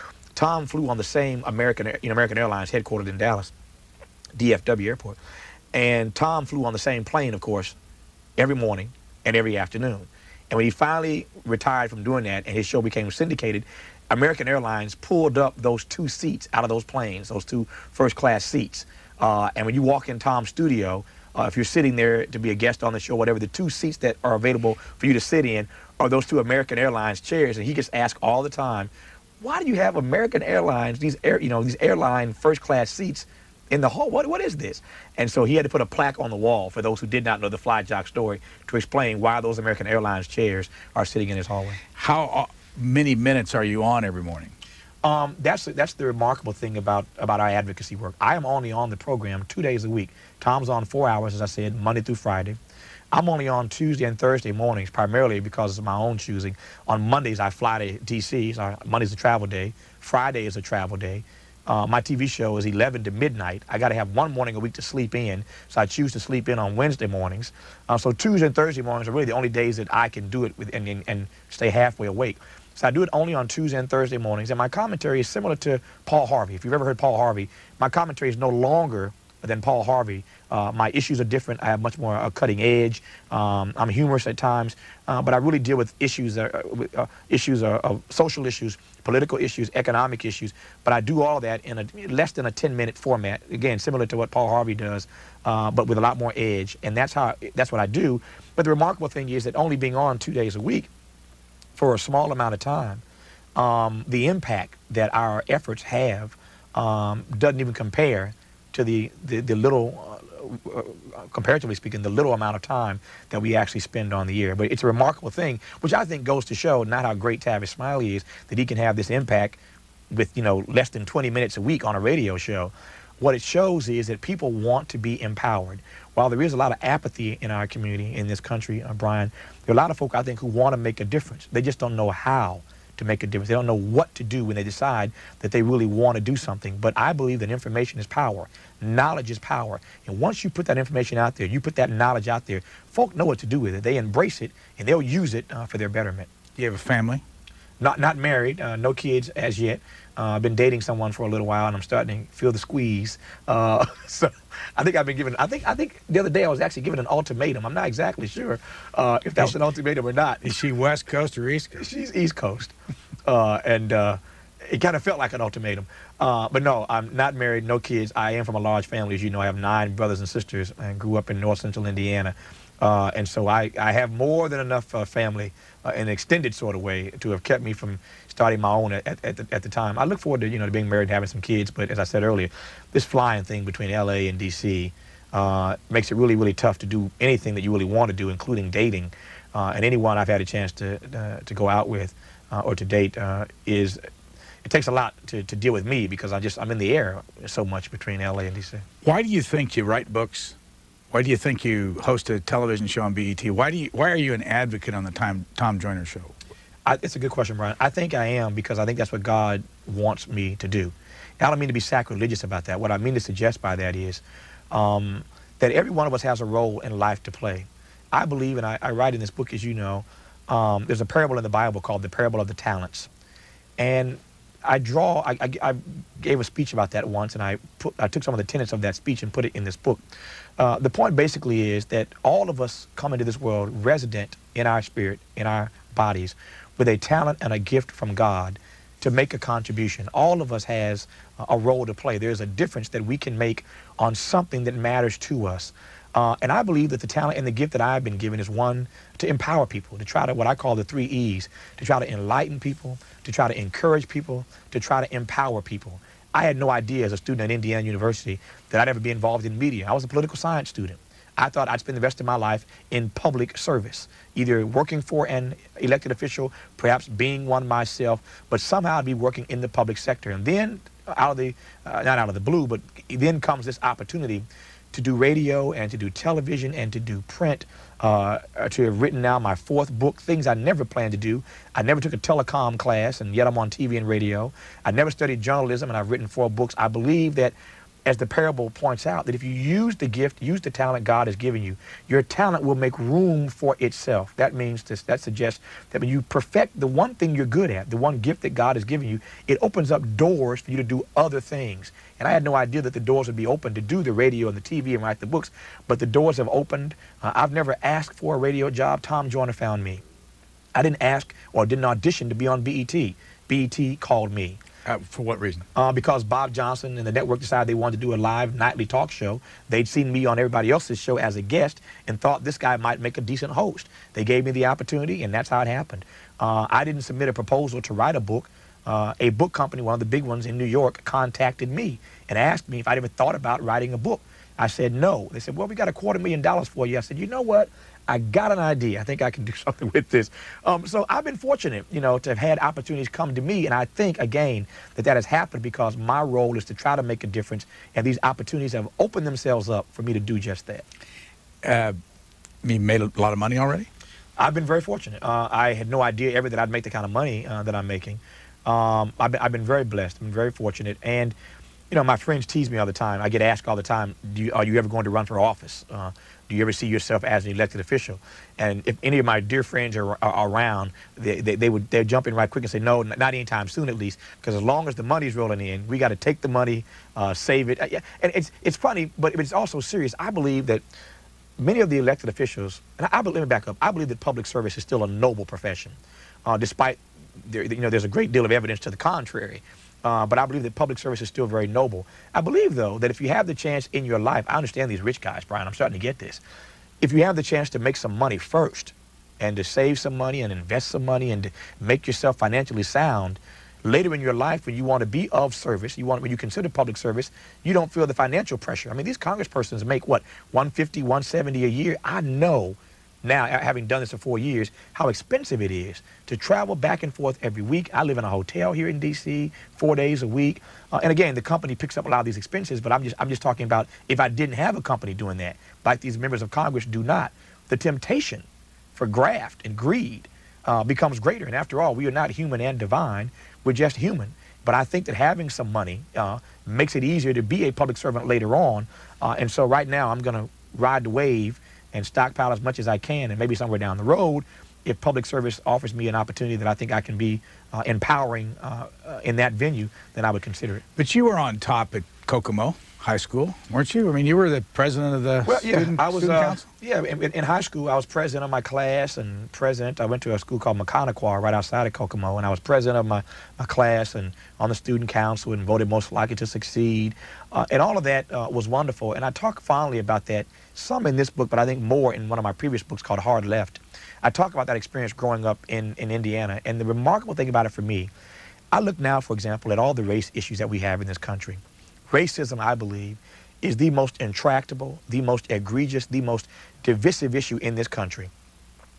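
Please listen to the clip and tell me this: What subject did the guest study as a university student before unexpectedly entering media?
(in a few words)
political science.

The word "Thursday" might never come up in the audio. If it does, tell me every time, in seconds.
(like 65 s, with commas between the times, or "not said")
54 s, 68 s, 73 s.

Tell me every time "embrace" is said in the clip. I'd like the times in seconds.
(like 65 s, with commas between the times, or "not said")
143 s.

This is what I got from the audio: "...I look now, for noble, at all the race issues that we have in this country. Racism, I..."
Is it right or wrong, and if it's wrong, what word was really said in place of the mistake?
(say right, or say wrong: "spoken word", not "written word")
wrong: "example", not "noble".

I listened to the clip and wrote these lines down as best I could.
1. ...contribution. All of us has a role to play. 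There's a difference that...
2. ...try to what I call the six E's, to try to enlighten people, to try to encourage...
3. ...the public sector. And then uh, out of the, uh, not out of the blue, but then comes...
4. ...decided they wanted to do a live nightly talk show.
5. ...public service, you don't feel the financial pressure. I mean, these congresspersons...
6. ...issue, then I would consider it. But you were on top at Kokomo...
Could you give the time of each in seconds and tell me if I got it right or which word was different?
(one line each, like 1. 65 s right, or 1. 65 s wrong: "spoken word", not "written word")
1. 239 s right
2. 250 s wrong: "three", not "six"
3. 269 s right
4. 317 s right
5. 406 s right
6. 449 s wrong: "venue", not "issue".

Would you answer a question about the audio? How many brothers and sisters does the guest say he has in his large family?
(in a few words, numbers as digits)
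9.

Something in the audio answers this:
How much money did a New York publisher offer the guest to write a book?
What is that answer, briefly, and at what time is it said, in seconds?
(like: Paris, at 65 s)
a quarter million dollars, at 335 s.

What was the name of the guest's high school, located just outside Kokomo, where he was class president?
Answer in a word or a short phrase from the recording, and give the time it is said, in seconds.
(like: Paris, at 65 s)
Maconaquah, at 460 s.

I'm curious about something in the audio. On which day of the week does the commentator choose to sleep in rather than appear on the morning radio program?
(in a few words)
Wednesday.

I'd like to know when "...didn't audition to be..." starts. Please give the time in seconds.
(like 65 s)
311 s.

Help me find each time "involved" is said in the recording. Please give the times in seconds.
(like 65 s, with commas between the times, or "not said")
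259 s.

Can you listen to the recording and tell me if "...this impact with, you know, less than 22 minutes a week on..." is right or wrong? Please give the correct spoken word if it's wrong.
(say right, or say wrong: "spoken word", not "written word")
wrong: "20", not "22".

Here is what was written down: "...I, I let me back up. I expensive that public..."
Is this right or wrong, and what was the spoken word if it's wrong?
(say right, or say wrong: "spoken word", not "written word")
wrong: "believe", not "expensive".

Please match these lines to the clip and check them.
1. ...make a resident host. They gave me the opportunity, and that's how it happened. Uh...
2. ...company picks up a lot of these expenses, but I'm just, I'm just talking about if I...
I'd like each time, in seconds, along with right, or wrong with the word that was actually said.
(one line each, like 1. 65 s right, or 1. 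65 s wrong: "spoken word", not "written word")
1. 322 s wrong: "decent", not "resident"
2. 421 s right.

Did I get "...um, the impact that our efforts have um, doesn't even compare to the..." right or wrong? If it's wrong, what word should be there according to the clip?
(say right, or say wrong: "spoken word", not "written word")
right.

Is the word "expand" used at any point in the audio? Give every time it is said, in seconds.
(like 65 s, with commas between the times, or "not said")
not said.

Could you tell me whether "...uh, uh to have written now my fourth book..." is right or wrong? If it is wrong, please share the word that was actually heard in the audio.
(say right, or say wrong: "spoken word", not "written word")
right.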